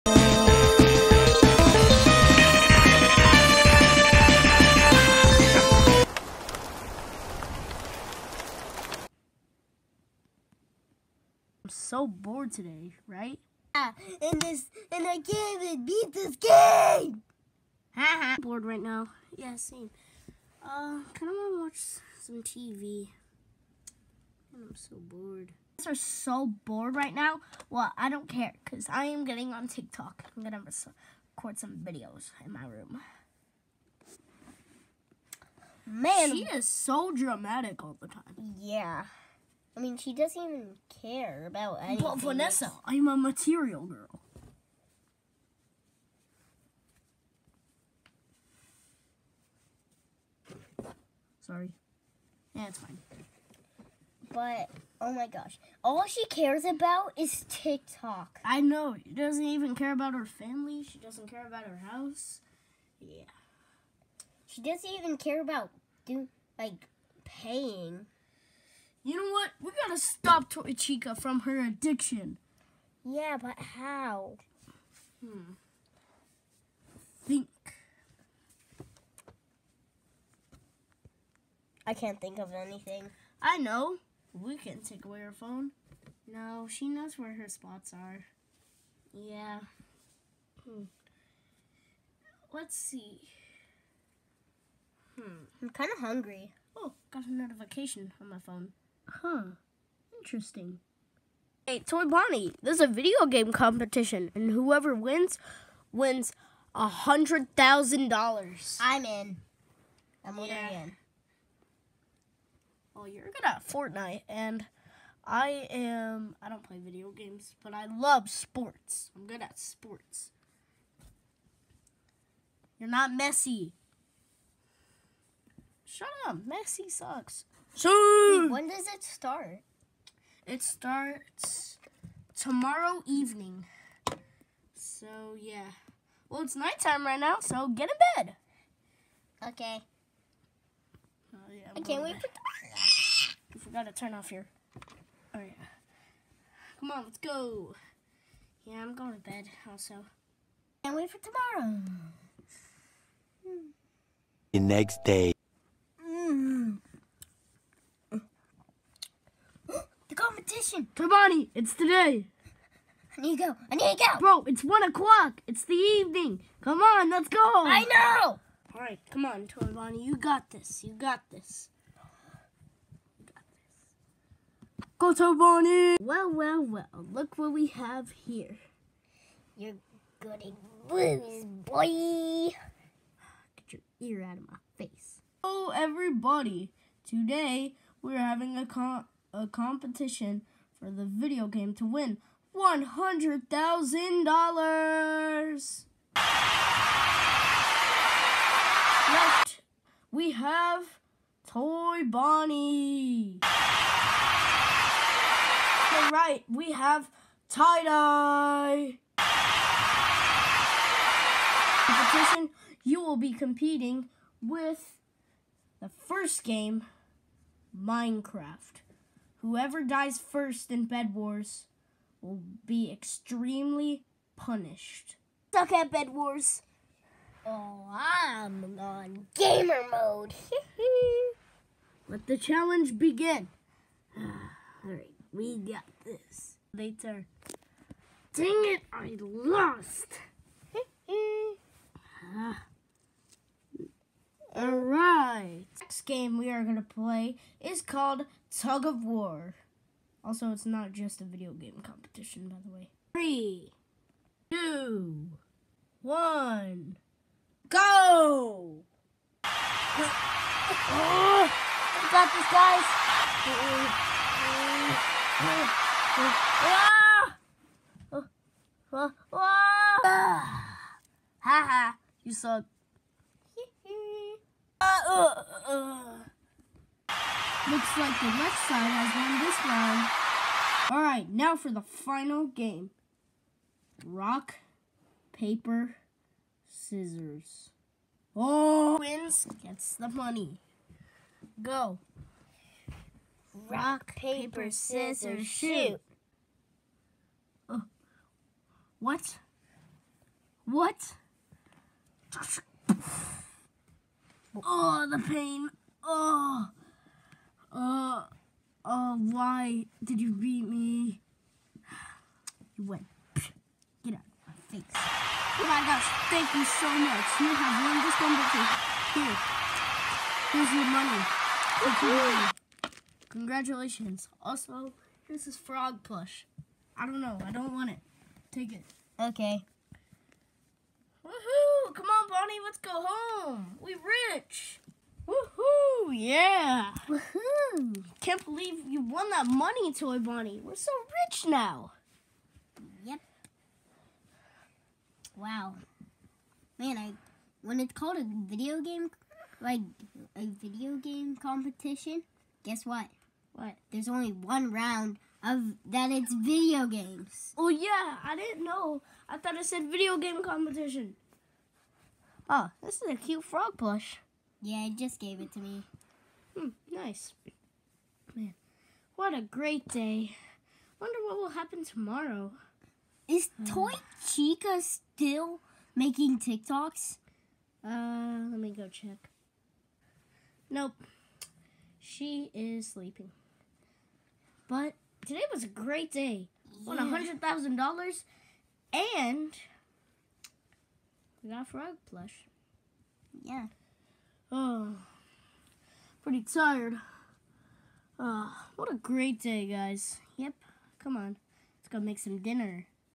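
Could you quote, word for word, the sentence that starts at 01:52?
Well, you're good at Fortnite, and I am.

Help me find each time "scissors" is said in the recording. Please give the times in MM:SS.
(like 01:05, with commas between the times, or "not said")
04:46, 04:54.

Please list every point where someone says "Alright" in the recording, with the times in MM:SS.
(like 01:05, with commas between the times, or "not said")
03:54, 04:40.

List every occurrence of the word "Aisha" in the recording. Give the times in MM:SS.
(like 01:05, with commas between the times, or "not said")
not said.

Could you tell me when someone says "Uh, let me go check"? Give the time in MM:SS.
06:17.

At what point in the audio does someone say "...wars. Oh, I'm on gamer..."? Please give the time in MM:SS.
03:46.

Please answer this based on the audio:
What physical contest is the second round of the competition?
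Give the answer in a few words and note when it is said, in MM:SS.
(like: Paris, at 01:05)
Tug of War, at 04:08.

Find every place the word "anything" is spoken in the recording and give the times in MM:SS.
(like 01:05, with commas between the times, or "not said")
00:41, 01:22.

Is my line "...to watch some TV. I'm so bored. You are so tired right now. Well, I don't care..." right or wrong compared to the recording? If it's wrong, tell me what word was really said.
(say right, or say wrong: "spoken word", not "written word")
wrong: "bored", not "tired".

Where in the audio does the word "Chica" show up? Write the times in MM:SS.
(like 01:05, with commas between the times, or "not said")
01:10, 06:14.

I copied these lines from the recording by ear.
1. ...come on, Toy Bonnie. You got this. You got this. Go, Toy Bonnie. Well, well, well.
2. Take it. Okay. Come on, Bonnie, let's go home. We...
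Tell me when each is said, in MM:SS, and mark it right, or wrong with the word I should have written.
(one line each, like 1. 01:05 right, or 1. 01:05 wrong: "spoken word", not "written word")
1. 02:49 right
2. 05:28 right.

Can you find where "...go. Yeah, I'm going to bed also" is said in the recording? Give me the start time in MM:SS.
02:27.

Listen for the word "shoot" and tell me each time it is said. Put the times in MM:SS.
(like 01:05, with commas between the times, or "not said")
04:55.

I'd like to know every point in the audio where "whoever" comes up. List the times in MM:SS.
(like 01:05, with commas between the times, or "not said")
01:44, 03:39.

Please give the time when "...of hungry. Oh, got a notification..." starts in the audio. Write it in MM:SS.
01:35.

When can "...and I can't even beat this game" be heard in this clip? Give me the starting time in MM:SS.
00:14.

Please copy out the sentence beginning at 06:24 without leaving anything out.
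But today was a great day.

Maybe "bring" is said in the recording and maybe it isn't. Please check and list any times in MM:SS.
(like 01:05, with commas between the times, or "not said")
not said.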